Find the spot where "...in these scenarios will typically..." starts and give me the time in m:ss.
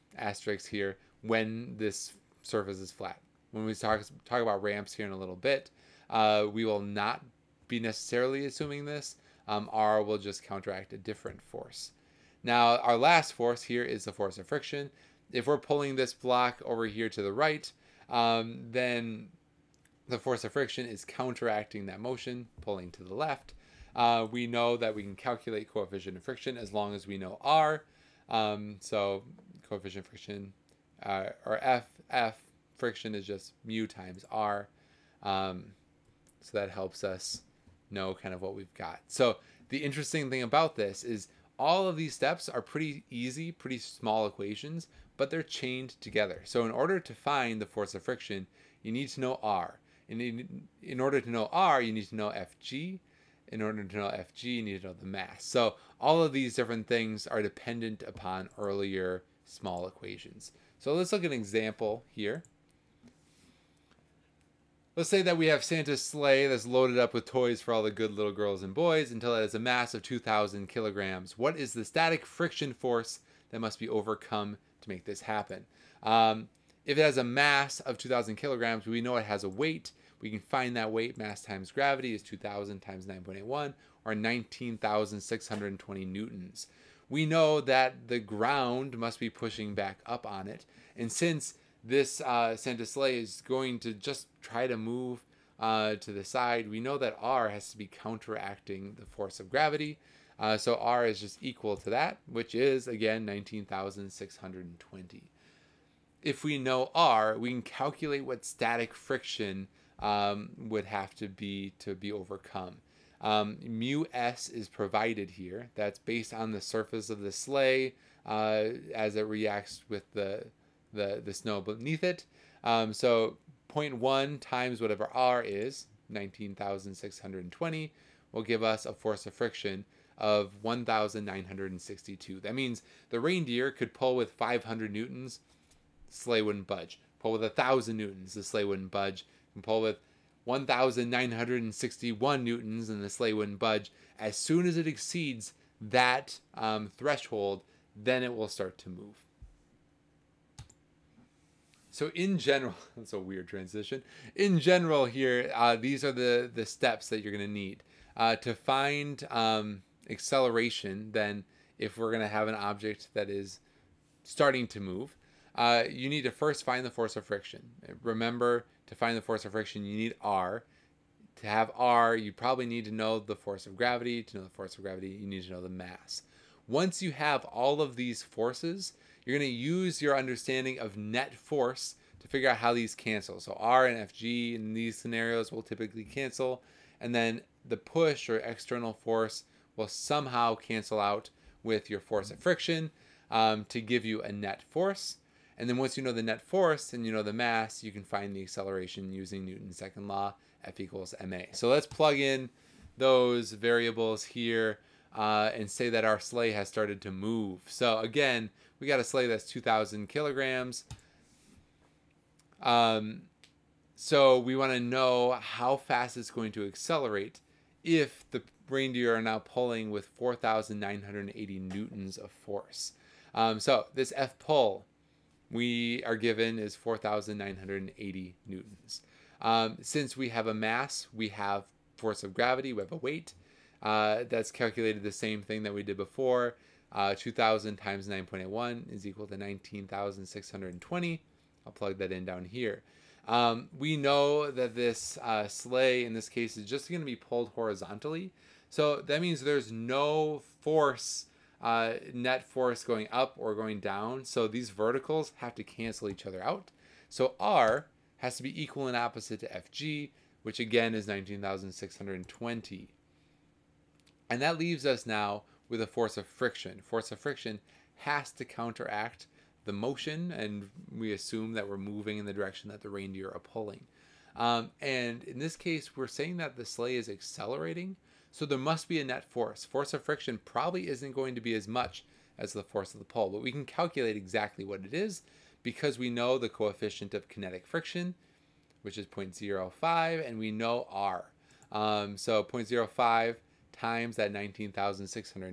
3:04.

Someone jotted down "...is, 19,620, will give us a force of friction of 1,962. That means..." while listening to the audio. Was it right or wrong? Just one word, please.
right.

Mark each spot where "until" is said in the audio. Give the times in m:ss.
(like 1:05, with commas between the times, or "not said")
1:09.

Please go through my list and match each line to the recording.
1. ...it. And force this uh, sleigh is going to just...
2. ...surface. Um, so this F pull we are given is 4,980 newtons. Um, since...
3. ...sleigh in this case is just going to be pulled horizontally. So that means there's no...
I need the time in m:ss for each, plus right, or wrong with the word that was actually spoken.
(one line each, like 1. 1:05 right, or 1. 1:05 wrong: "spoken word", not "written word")
1. 1:30 wrong: "since", not "force"
2. 3:42 wrong: "force", not "surface"
3. 4:05 right.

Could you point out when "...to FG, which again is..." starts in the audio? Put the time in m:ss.
4:19.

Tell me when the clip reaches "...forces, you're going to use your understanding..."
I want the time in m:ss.
2:58.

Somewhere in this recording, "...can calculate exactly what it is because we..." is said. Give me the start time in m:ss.
4:43.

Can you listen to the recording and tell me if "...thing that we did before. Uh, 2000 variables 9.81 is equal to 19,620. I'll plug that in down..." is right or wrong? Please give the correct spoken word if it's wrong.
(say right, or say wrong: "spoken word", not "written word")
wrong: "times", not "variables".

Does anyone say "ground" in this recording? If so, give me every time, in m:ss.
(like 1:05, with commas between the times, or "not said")
1:28.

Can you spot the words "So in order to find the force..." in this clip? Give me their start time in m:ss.
0:46.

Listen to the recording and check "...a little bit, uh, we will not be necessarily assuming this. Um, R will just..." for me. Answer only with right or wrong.
right.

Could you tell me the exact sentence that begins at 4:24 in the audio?
And that leaves us now with a force of friction.